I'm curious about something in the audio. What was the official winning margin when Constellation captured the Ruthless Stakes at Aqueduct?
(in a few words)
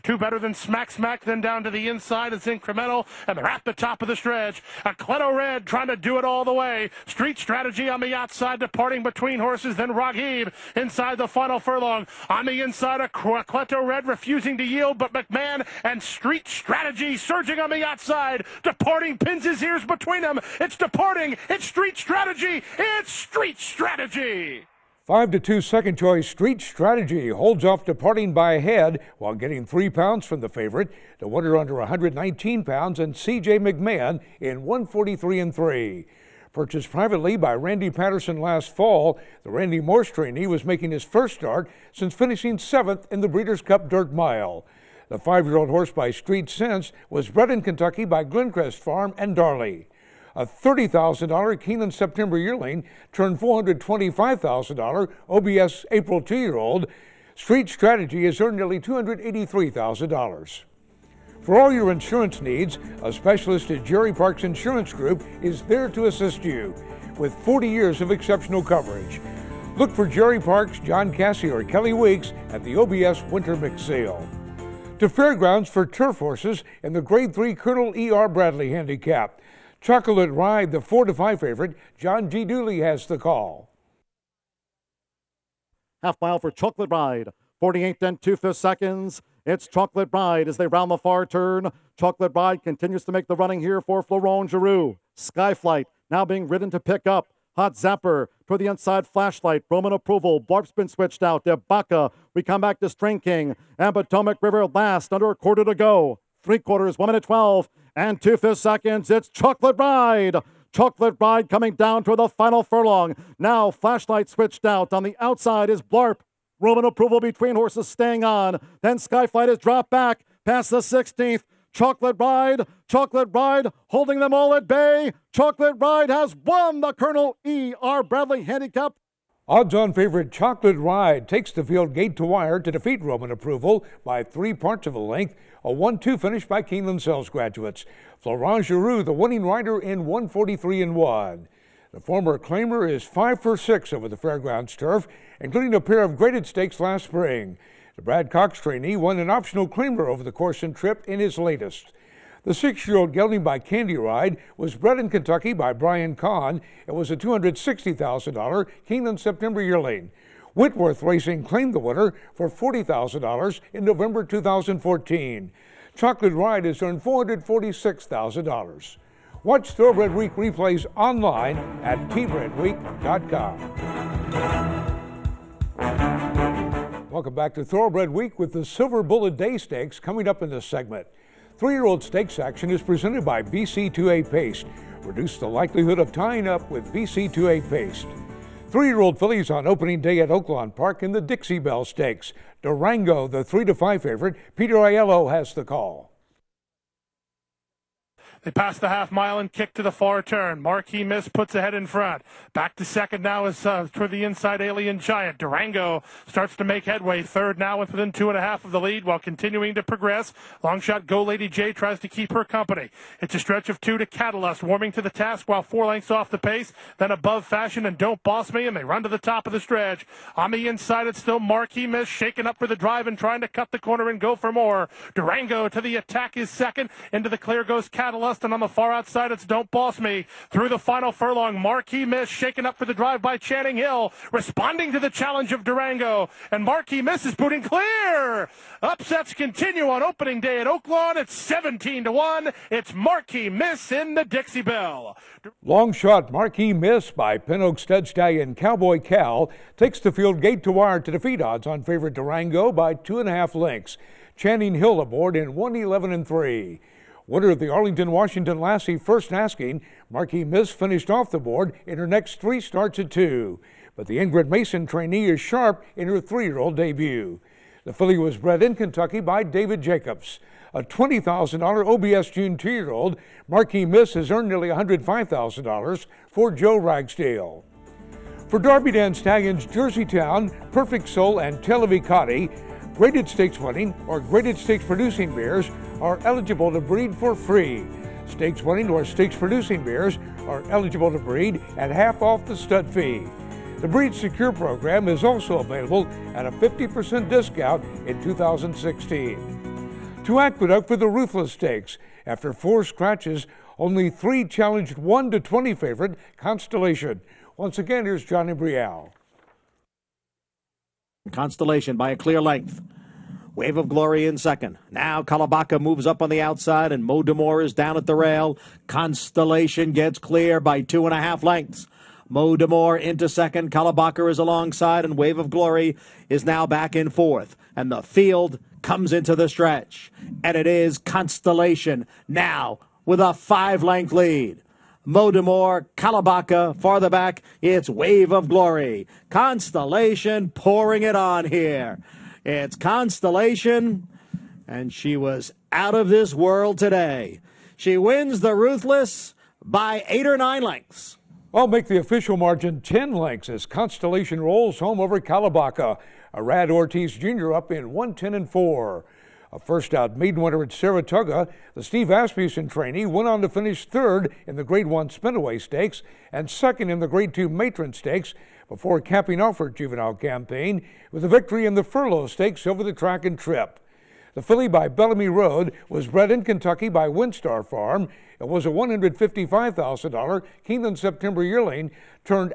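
10 lengths.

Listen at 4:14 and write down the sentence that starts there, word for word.
Channing Hill aboard in 111 and 3.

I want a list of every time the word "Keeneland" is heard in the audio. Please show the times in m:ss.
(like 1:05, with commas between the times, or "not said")
0:51, 2:16, 2:38, 6:20.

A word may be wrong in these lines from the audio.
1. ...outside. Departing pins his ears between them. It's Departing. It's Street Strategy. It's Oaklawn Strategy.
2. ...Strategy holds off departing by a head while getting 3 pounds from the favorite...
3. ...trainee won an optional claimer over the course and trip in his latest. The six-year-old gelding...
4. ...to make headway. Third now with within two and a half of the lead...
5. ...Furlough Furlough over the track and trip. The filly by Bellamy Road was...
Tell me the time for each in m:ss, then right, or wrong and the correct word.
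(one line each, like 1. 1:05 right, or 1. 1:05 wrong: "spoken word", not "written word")
1. 0:17 wrong: "Street", not "Oaklawn"
2. 0:26 right
3. 2:28 right
4. 3:26 right
5. 6:11 wrong: "Stakes", not "Furlough".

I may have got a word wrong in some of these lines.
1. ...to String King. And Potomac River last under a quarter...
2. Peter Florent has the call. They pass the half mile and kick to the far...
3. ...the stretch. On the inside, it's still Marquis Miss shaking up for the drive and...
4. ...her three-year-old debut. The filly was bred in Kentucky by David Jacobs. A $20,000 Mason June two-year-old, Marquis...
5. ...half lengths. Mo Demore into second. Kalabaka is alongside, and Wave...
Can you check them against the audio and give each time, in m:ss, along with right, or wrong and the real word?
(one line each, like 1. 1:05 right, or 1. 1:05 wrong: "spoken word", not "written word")
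1. 1:42 right
2. 3:14 wrong: "Aiello", not "Florent"
3. 3:39 right
4. 4:26 wrong: "OBS", not "Mason"
5. 5:21 right.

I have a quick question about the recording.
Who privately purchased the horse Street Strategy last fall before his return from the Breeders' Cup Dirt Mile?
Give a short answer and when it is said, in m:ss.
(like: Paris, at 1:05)
Randy Patterson, at 0:37.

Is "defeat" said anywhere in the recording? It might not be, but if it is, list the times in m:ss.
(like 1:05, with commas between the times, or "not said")
2:12, 4:11.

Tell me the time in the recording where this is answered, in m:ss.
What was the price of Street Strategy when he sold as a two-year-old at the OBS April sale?
0:53.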